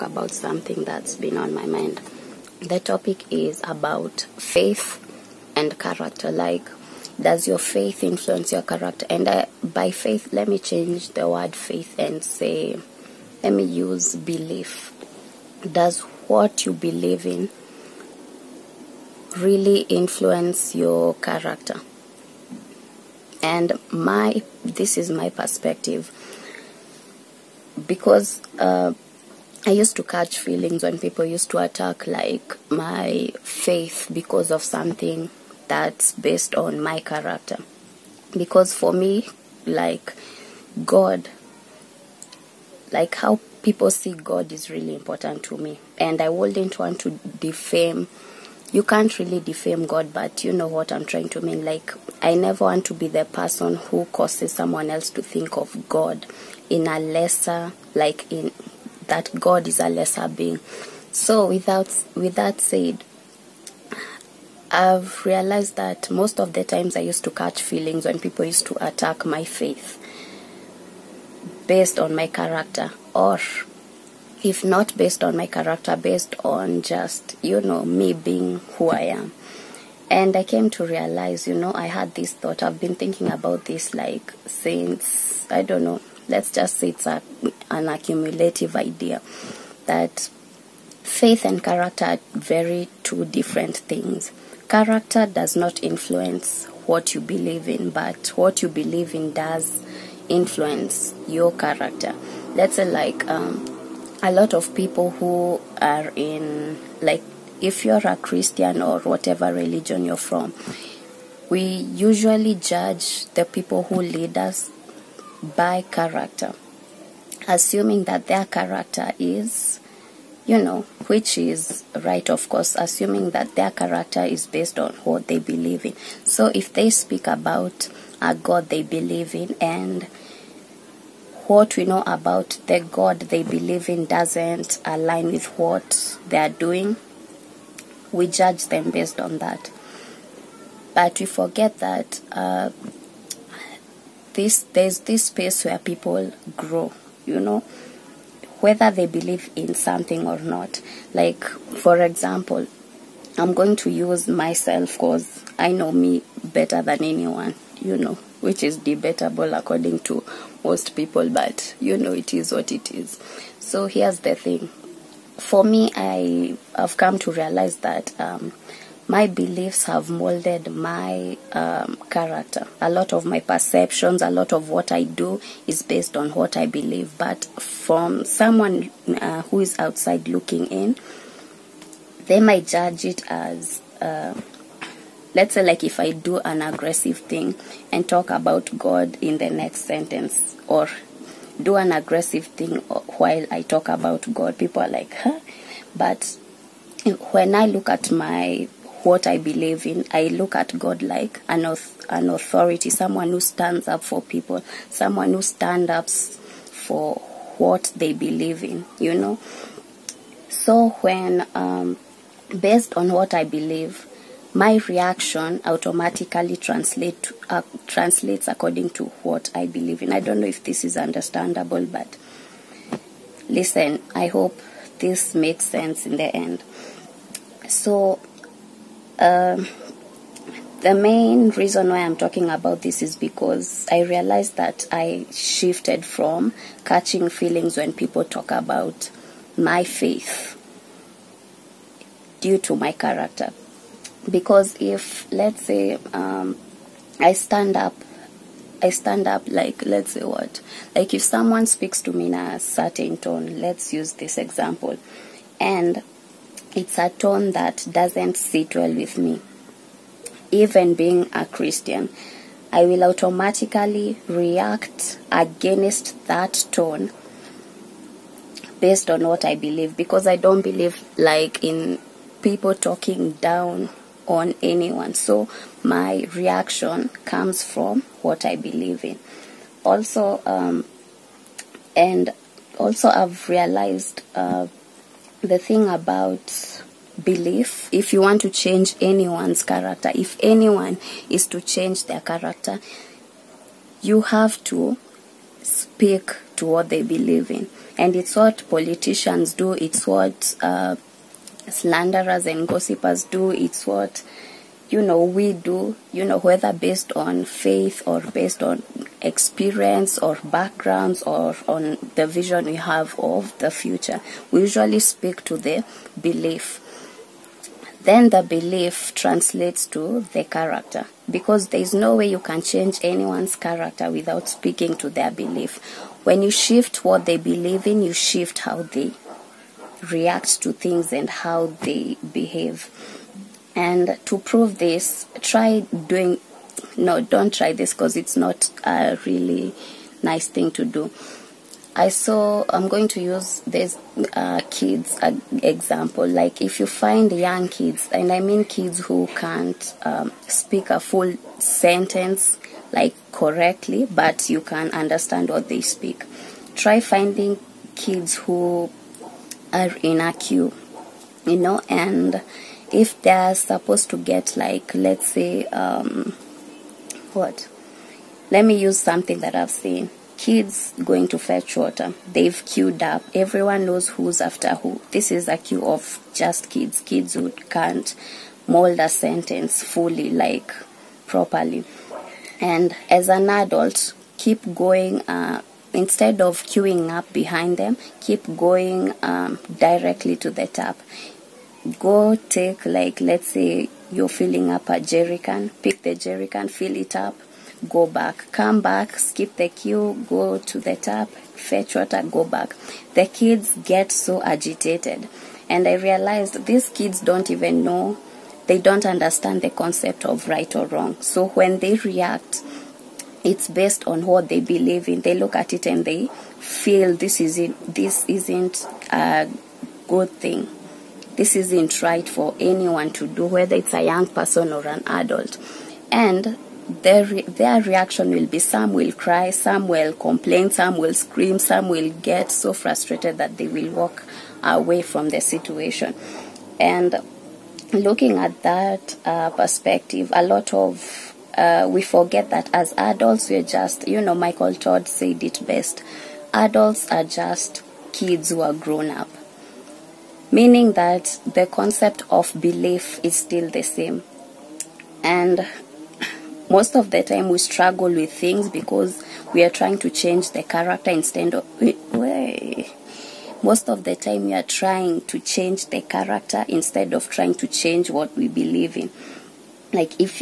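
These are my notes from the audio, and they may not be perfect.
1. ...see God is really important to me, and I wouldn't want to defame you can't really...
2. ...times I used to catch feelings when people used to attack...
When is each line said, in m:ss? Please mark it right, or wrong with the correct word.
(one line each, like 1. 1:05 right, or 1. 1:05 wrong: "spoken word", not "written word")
1. 0:43 right
2. 1:06 right.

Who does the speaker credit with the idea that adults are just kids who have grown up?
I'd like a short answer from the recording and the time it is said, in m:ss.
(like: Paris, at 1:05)
Michael Todd, at 7:24.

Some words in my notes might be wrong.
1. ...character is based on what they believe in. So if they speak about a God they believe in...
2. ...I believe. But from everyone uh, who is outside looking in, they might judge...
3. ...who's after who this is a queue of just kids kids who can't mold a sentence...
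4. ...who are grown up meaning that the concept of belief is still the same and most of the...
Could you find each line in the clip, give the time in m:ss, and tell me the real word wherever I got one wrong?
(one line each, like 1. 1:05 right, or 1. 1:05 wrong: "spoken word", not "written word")
1. 2:03 right
2. 2:56 wrong: "someone", not "everyone"
3. 6:14 right
4. 7:28 right.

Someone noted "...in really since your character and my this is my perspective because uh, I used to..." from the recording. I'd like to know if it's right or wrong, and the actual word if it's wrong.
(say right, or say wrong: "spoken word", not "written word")
wrong: "influence", not "since".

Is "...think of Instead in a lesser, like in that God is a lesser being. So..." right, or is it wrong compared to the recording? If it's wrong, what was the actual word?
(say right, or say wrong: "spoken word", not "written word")
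wrong: "God", not "Instead".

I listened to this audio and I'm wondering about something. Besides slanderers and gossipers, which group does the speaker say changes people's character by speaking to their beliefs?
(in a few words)
politicians.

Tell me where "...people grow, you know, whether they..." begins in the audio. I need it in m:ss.
2:25.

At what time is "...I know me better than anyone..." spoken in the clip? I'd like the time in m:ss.
2:35.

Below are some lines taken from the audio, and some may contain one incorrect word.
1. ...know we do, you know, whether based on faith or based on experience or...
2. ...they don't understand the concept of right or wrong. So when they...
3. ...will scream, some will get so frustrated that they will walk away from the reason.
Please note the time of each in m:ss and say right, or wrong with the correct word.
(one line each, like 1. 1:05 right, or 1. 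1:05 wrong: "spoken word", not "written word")
1. 5:05 right
2. 6:48 right
3. 7:10 wrong: "situation", not "reason".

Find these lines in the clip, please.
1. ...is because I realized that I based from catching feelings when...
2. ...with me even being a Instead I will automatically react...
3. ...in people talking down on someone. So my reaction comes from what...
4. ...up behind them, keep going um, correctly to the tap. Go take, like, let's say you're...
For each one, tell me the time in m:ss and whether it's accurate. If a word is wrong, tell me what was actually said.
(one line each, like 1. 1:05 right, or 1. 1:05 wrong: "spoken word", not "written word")
1. 3:53 wrong: "shifted", not "based"
2. 4:18 wrong: "Christian", not "Instead"
3. 4:31 wrong: "anyone", not "someone"
4. 6:27 wrong: "directly", not "correctly".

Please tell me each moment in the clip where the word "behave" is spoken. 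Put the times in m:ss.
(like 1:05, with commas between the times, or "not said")
5:32.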